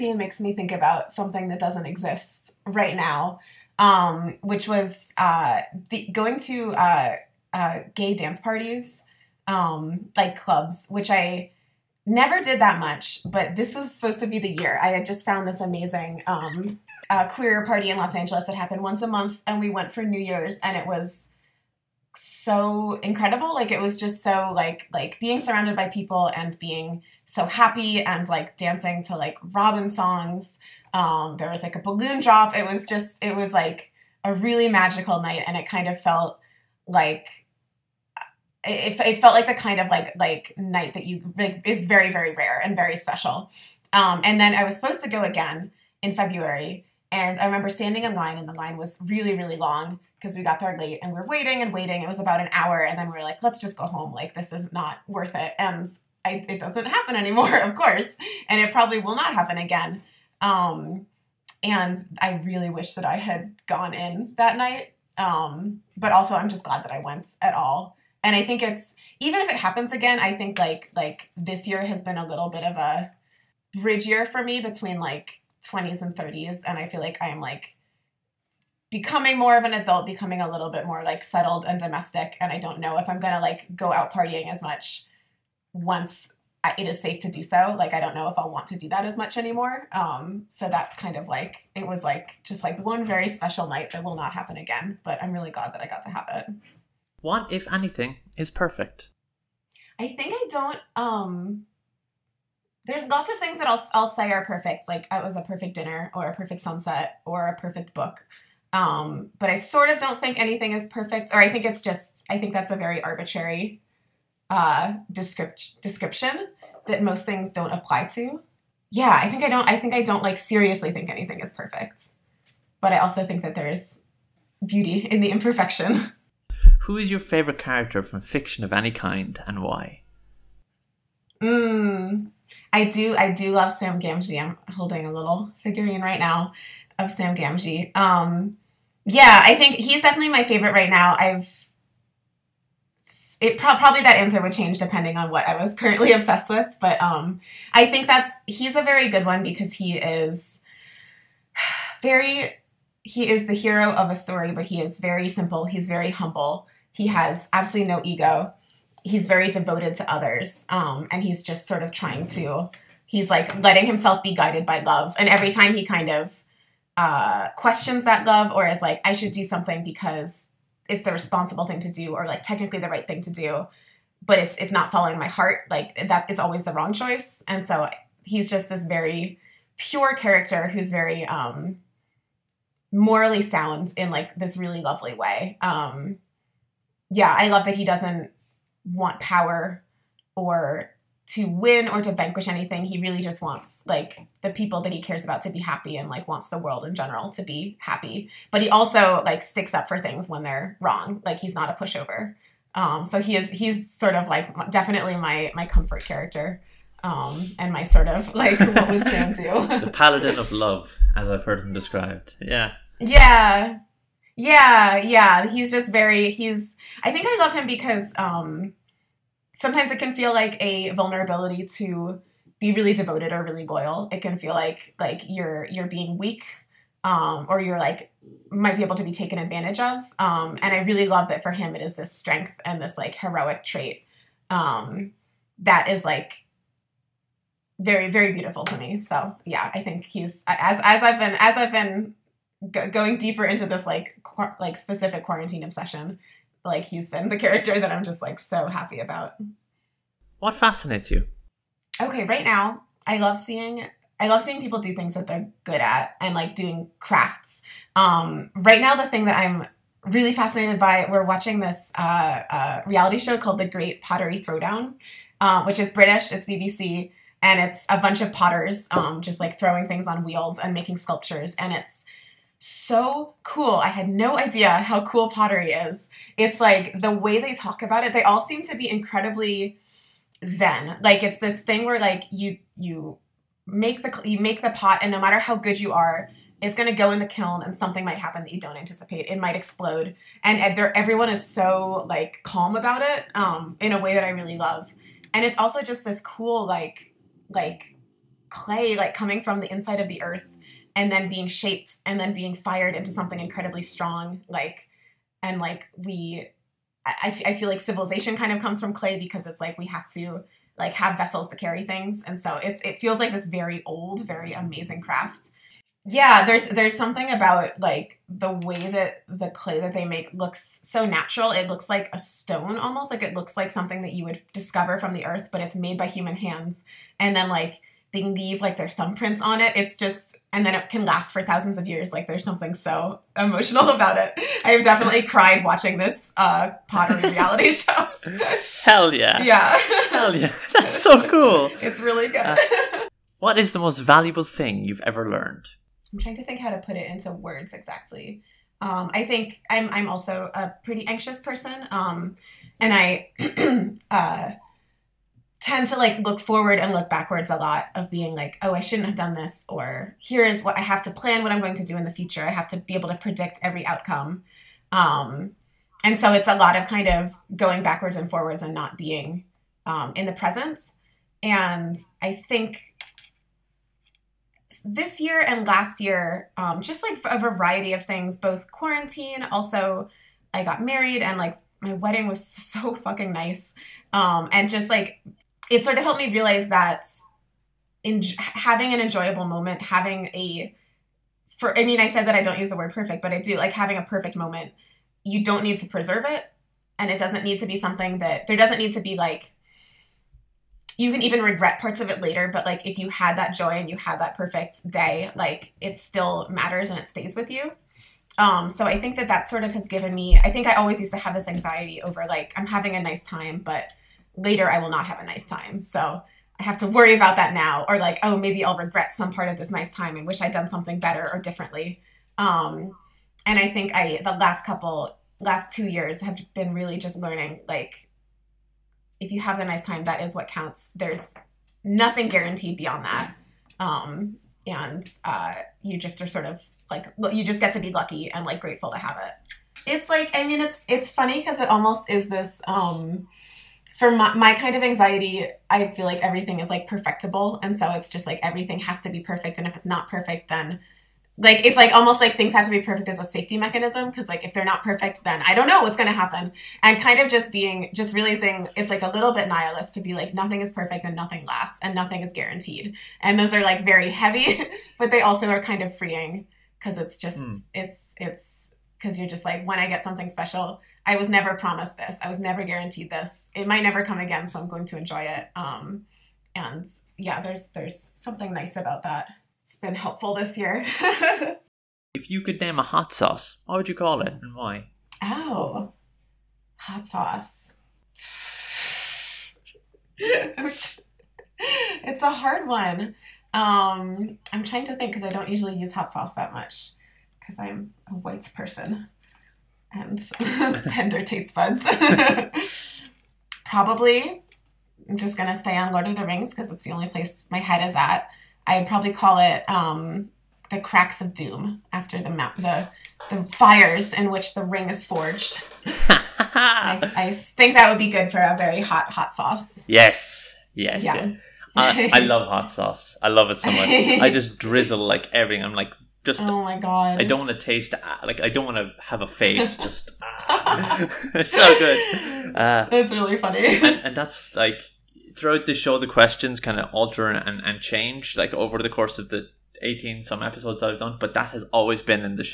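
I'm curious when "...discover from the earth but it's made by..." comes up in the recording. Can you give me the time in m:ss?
5:24.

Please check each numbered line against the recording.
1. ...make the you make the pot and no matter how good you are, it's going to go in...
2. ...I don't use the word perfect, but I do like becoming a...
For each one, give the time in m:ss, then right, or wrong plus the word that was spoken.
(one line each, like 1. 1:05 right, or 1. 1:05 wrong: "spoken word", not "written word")
1. 4:43 right
2. 6:32 wrong: "having", not "becoming".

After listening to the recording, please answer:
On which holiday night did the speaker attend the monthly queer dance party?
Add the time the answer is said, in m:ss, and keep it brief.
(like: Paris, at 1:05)
New Year's, at 0:20.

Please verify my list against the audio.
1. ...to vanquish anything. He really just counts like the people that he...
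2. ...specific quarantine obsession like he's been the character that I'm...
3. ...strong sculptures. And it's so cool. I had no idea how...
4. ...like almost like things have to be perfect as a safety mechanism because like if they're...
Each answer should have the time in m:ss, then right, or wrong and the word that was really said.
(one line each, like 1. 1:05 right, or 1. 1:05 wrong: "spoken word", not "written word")
1. 3:12 wrong: "wants", not "counts"
2. 4:04 right
3. 4:30 wrong: "making", not "strong"
4. 7:31 right.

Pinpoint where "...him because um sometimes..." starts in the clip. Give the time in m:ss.
3:37.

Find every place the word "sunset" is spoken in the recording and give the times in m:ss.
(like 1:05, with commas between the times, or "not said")
1:46.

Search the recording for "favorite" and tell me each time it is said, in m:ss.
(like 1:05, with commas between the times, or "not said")
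2:07, 2:20.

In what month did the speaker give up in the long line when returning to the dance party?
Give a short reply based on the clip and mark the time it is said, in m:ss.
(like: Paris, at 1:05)
February, at 0:46.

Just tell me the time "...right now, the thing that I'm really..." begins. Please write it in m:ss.
4:18.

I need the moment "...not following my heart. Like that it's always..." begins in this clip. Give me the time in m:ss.
2:54.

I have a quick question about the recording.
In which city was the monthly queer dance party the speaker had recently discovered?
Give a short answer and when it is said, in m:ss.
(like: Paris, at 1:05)
Los Angeles, at 0:17.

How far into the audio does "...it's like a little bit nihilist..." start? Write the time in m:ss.
7:38.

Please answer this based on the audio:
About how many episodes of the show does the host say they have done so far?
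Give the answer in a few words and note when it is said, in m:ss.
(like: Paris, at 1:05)
18, at 8:59.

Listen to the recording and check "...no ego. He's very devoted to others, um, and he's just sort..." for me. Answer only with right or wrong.
right.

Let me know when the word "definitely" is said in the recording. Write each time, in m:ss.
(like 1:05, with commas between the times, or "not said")
2:20, 3:24, 5:34.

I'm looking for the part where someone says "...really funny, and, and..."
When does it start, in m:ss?
8:53.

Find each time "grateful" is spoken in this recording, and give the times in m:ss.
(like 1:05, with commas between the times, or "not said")
7:18.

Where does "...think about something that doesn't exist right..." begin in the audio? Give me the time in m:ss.
0:00.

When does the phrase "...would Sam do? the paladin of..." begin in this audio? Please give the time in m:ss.
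3:28.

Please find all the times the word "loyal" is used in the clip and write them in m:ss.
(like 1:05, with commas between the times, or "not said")
3:43.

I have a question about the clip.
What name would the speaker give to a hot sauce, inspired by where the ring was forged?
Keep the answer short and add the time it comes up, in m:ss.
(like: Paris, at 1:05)
The Cracks of Doom, at 8:30.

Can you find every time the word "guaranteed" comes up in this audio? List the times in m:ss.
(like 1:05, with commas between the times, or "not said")
7:12, 7:42, 7:52.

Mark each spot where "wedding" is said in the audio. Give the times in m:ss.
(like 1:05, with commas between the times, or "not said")
6:21.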